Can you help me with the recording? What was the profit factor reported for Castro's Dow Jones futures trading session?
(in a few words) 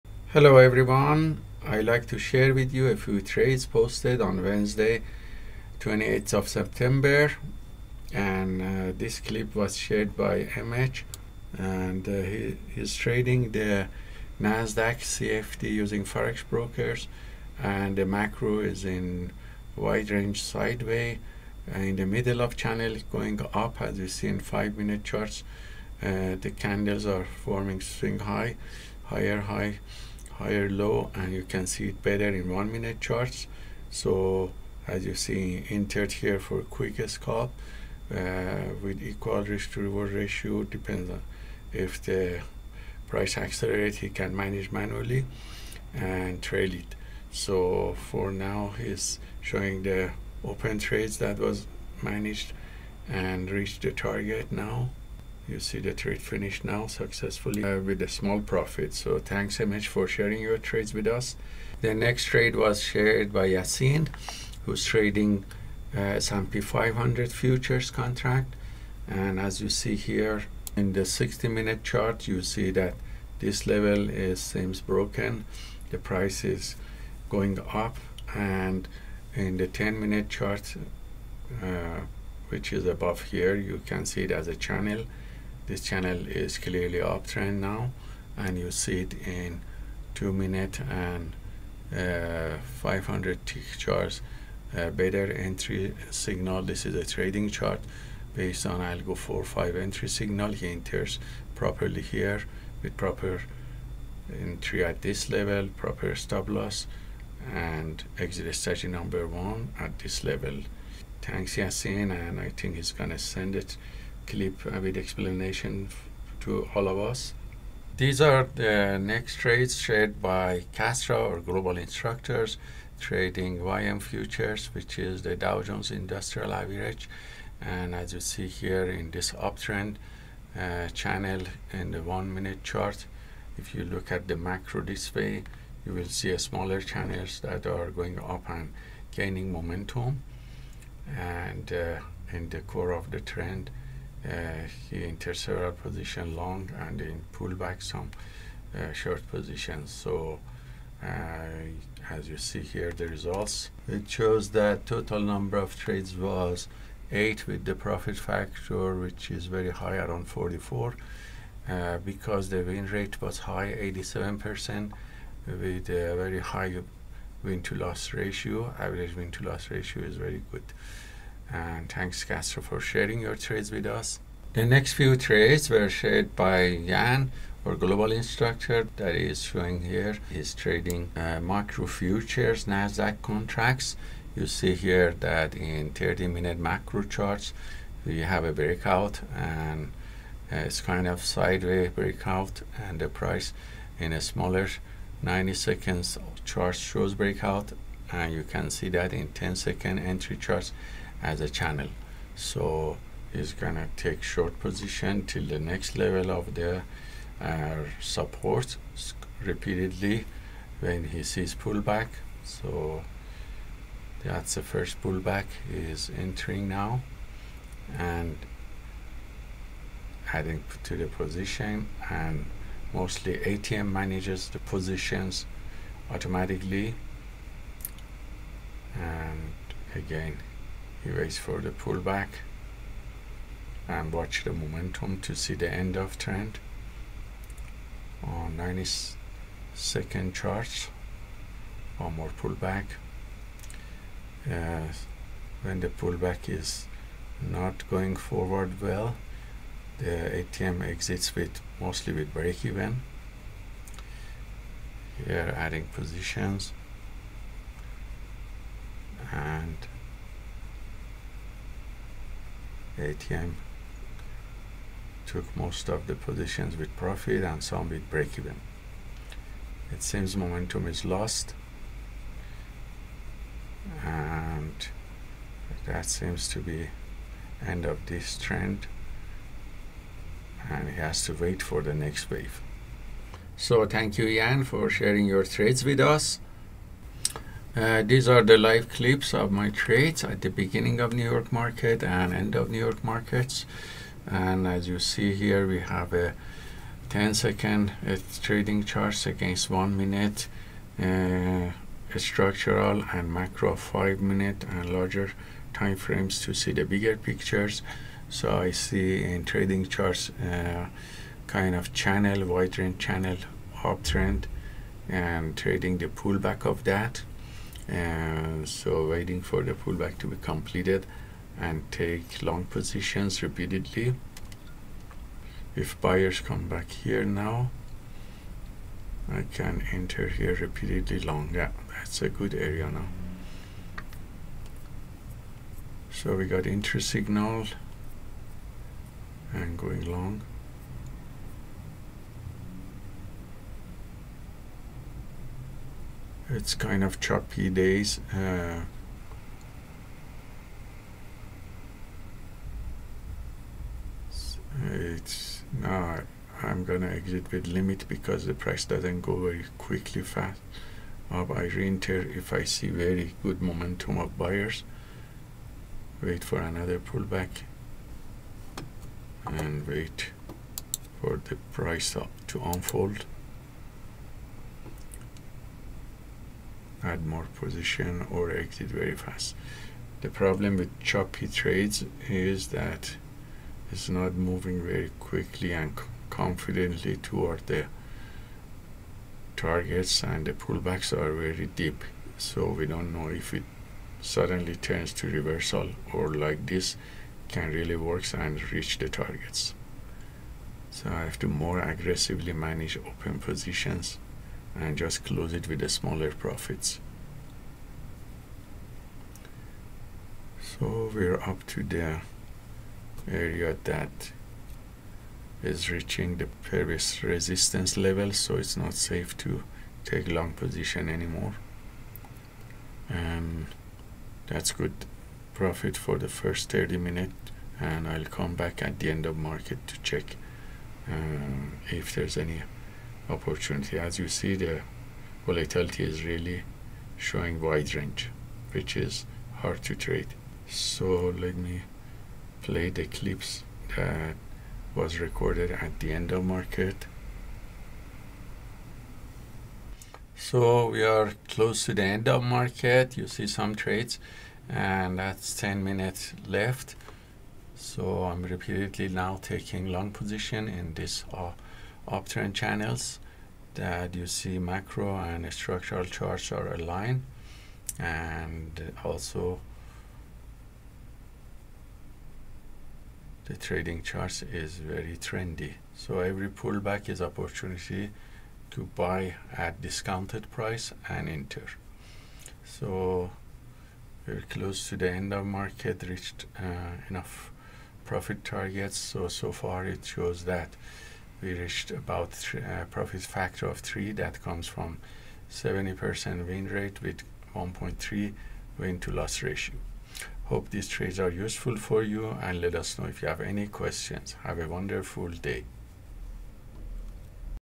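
44.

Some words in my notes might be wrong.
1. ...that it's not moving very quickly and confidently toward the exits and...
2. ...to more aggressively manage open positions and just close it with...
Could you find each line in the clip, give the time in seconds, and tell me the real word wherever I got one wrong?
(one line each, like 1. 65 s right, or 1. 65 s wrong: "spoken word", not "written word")
1. 382 s wrong: "targets", not "exits"
2. 401 s right.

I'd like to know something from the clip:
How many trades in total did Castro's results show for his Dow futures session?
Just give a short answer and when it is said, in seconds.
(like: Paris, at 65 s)
8, at 157 s.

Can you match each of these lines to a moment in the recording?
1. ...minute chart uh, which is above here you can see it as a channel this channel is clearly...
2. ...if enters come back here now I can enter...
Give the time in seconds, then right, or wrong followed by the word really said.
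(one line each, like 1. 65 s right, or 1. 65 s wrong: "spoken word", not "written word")
1. 79 s right
2. 325 s wrong: "buyers", not "enters".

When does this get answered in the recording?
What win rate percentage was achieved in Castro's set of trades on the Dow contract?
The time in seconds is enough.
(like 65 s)
163 s.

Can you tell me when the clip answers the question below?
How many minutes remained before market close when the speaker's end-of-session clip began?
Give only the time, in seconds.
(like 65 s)
455 s.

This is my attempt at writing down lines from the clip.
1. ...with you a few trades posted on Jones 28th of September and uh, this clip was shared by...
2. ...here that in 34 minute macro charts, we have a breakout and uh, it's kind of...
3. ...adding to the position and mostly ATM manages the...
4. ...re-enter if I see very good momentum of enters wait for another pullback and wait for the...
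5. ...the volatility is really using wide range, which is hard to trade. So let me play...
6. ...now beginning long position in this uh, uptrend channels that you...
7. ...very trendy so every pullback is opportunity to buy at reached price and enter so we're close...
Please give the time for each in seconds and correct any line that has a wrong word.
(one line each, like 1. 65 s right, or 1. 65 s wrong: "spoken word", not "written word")
1. 2 s wrong: "Wednesday", not "Jones"
2. 184 s wrong: "30", not "34"
3. 220 s right
4. 361 s wrong: "buyers", not "enters"
5. 434 s wrong: "showing", not "using"
6. 459 s wrong: "taking", not "beginning"
7. 474 s wrong: "discounted", not "reached".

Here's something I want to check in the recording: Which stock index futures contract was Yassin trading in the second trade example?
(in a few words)
S&P 500.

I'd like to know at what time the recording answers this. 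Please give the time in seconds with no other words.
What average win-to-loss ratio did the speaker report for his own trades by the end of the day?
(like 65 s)
497 s.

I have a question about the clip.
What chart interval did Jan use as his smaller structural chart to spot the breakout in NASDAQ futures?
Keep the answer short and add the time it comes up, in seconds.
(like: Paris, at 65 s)
90 seconds, at 195 s.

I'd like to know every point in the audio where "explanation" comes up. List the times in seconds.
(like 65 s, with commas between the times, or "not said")
114 s.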